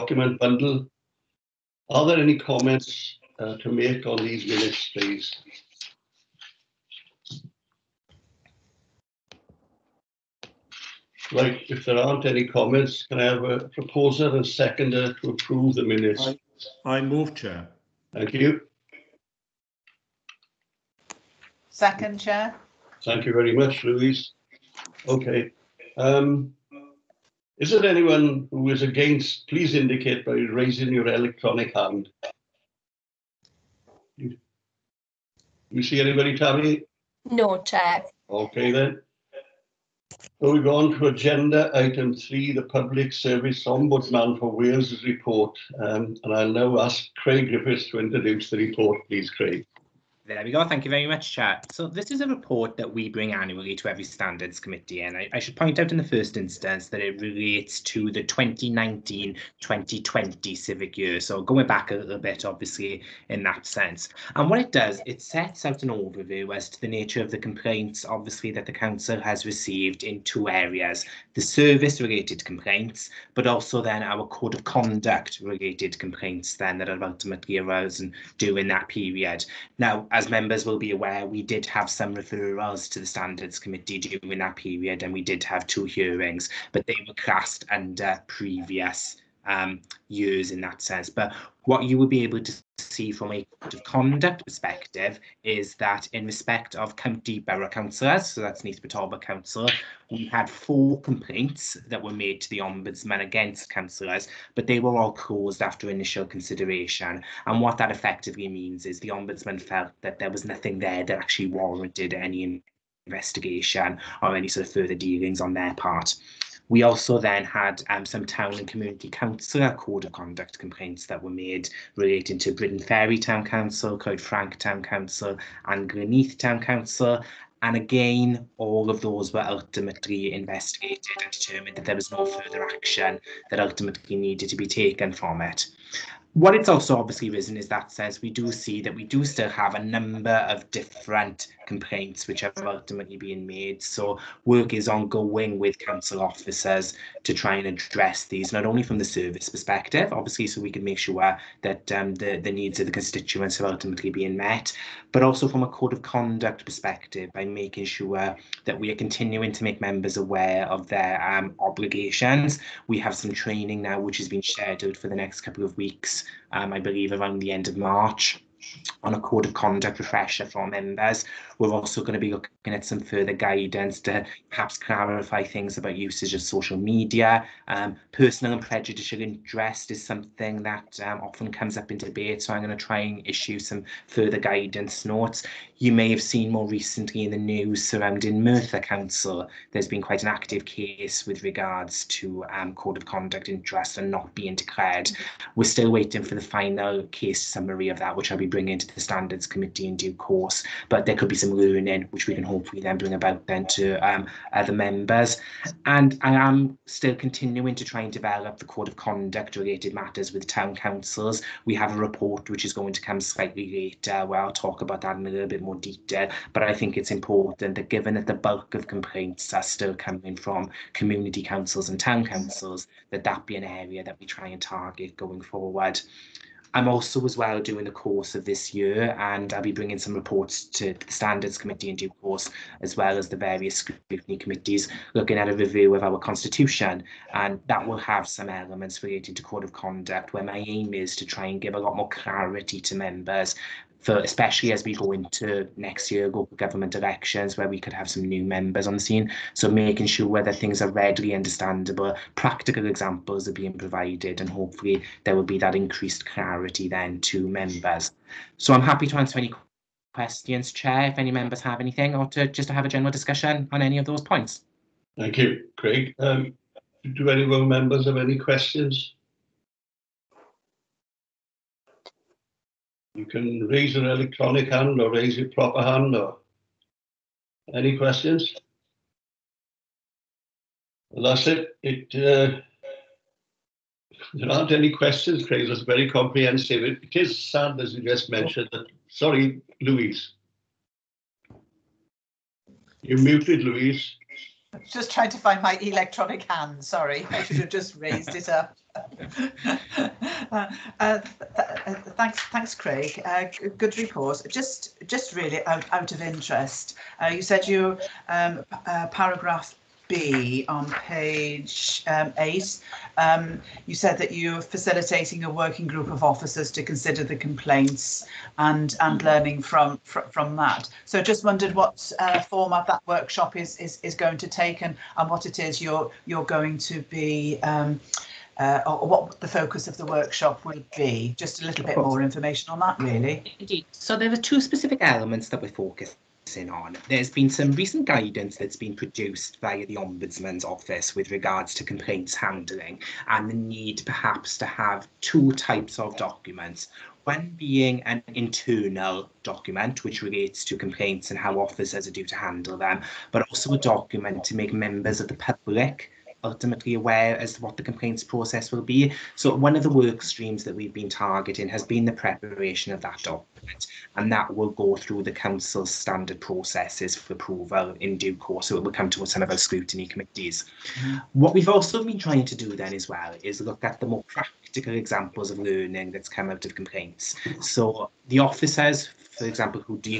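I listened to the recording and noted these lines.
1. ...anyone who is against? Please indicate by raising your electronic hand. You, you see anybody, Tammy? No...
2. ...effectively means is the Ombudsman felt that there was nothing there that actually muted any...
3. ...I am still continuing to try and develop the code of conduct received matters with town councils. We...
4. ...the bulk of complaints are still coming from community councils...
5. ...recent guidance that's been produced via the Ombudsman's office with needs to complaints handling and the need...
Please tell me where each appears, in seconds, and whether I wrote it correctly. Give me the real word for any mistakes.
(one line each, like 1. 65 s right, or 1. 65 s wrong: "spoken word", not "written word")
1. 27 s right
2. 107 s wrong: "warranted", not "muted"
3. 206 s wrong: "related", not "received"
4. 218 s right
5. 337 s wrong: "regards", not "needs".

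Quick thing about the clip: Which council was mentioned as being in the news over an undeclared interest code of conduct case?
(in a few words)
Merthyr Council.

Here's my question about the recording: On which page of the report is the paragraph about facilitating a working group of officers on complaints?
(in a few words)
8.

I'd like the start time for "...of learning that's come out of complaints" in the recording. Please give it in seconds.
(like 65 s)
375 s.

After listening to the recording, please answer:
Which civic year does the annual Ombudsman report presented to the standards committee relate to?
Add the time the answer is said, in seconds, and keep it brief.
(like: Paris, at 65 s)
2019-2020, at 58 s.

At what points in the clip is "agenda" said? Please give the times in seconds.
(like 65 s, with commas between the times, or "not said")
41 s.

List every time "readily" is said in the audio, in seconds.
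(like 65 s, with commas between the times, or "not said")
250 s.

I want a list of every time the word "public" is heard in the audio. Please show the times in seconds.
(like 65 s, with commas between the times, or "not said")
42 s, 355 s.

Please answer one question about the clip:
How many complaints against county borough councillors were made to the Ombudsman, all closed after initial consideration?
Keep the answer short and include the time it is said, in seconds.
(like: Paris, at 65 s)
4, at 100 s.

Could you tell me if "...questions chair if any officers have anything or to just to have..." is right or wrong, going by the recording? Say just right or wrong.
wrong.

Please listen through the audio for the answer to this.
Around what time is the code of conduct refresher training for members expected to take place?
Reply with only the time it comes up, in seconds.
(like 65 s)
167 s.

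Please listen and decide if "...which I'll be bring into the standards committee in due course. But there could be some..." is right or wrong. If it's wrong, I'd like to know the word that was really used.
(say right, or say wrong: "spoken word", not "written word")
right.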